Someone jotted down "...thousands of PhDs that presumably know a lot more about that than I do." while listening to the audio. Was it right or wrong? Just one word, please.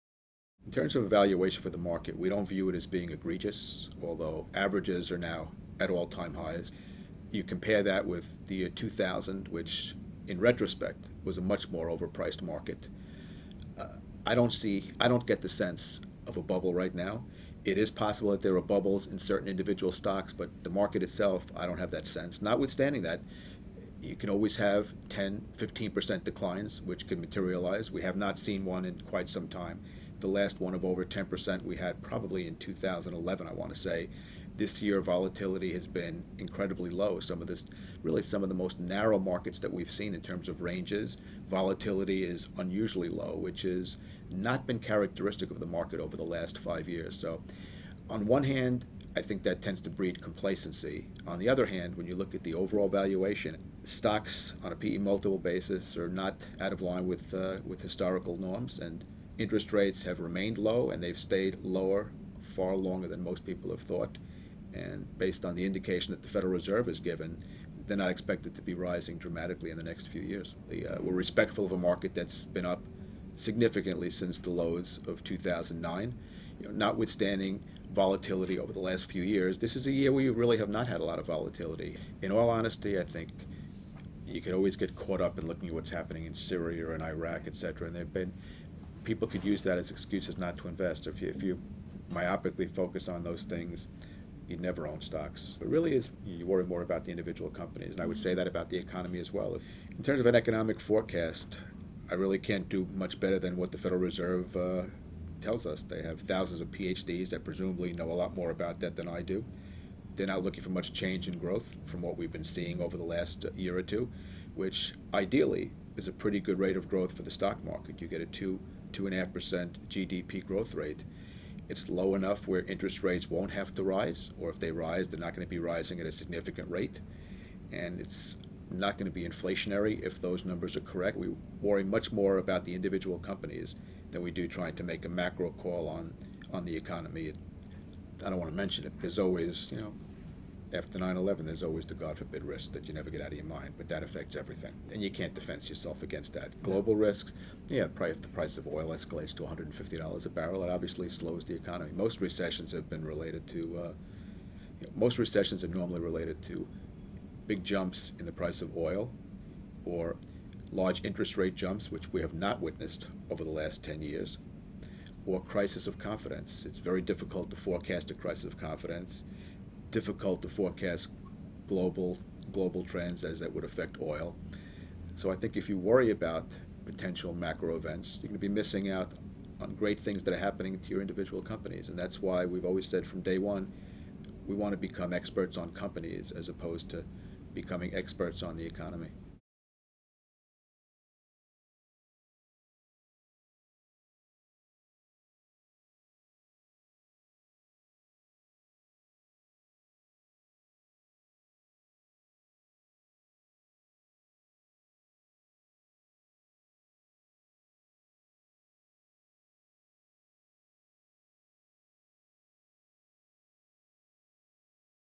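right.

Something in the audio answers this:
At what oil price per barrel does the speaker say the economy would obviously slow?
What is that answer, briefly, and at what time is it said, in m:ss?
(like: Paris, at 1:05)
$150, at 2:29.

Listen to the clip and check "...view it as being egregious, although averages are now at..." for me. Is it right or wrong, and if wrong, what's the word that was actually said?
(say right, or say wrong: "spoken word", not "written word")
right.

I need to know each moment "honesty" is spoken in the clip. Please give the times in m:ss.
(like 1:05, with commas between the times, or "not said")
1:22.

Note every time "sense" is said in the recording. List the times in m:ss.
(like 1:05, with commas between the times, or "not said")
0:15, 0:22.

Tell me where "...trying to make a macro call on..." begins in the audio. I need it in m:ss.
2:14.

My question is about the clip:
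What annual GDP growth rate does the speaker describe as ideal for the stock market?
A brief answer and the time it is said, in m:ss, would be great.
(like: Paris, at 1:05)
2.5%, at 1:58.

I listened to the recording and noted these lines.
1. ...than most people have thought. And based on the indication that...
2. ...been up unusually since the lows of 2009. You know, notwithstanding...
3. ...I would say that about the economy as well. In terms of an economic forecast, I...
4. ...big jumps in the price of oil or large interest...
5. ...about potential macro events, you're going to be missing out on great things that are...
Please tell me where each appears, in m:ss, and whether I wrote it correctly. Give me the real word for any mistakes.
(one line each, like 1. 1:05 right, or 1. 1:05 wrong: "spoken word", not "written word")
1. 1:03 right
2. 1:12 wrong: "significantly", not "unusually"
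3. 1:38 right
4. 2:37 right
5. 2:56 right.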